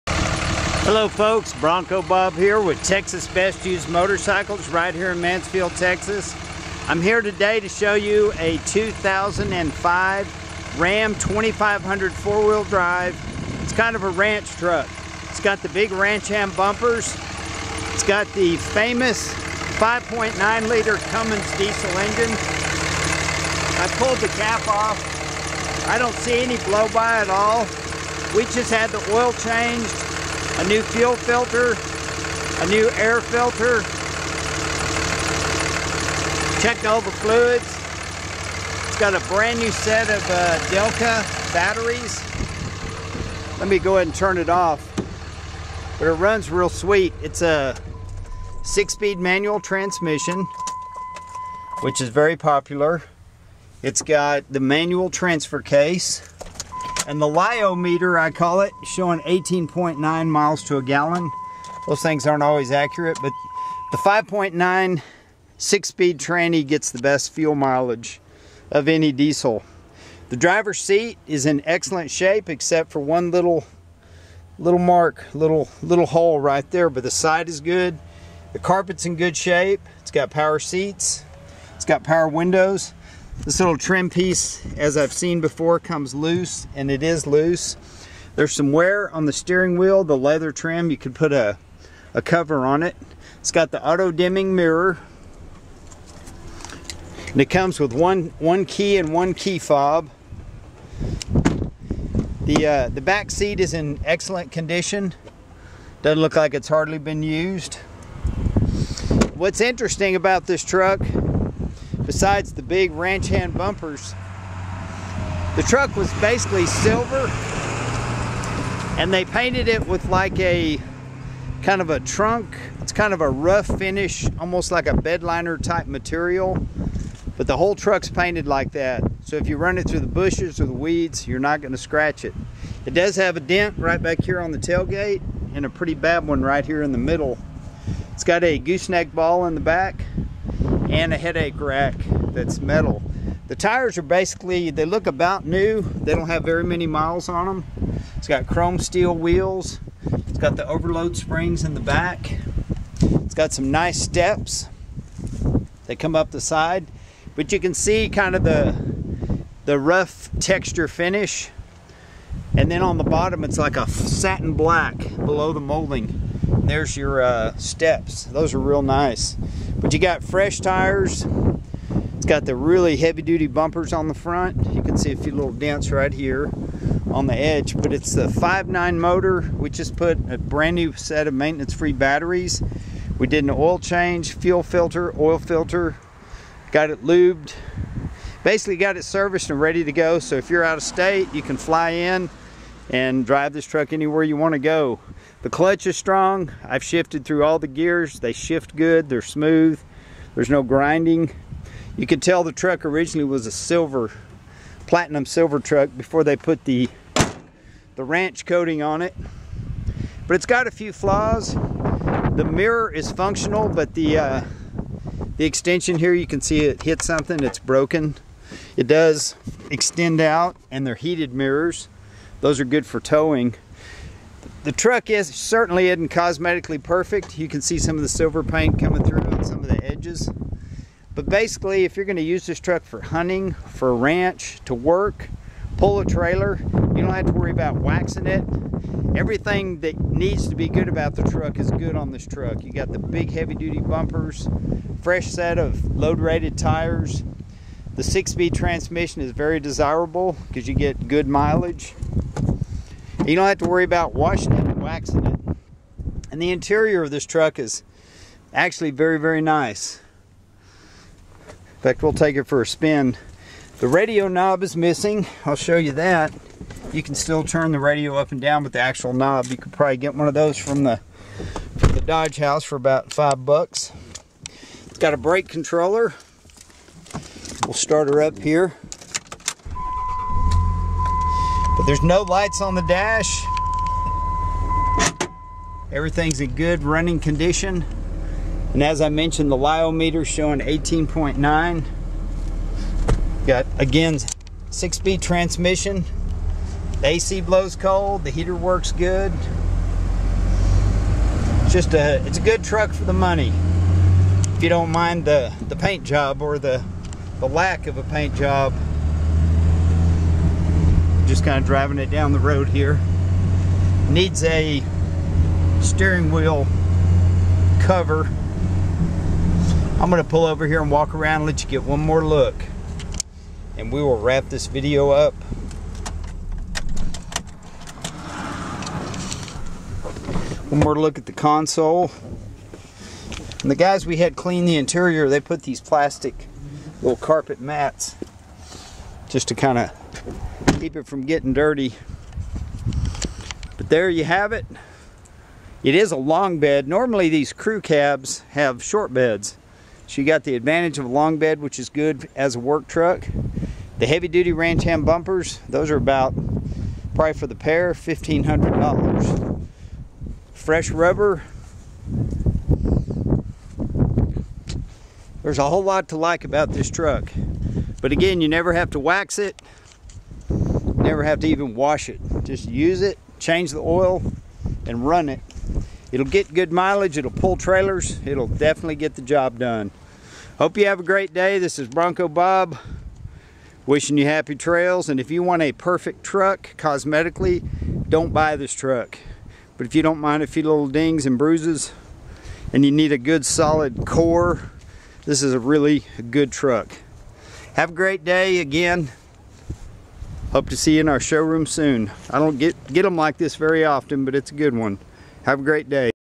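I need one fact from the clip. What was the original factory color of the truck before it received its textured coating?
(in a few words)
platinum silver.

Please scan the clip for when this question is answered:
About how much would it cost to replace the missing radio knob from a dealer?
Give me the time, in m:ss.
4:33.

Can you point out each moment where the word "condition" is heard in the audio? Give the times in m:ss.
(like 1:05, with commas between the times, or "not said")
1:44, 4:47.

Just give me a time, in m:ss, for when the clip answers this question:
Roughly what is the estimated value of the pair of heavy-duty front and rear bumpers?
5:57.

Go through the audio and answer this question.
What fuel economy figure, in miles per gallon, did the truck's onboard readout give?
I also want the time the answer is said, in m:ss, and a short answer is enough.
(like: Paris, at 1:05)
18.9, at 0:59.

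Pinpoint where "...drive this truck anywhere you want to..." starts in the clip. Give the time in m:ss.
3:13.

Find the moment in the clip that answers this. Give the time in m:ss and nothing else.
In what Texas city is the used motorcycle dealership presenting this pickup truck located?
0:05.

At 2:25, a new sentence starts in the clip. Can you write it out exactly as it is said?
They don't have very many miles on them.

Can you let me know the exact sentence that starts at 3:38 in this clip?
It does extend out, and they're heated mirrors.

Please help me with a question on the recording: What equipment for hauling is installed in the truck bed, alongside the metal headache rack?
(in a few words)
gooseneck ball.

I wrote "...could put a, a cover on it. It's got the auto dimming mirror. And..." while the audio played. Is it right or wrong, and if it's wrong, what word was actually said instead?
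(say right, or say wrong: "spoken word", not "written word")
right.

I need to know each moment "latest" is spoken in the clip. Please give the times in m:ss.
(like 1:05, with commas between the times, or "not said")
not said.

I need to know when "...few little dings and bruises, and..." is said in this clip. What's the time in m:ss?
6:30.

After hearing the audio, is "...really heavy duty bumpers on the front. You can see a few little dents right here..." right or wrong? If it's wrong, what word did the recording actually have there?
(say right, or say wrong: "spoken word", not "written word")
right.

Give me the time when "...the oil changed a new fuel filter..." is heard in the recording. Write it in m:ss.
0:28.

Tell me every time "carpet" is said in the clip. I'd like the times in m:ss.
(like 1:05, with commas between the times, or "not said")
1:18, 5:37.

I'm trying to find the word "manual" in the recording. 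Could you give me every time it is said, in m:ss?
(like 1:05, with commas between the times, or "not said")
0:49, 0:54.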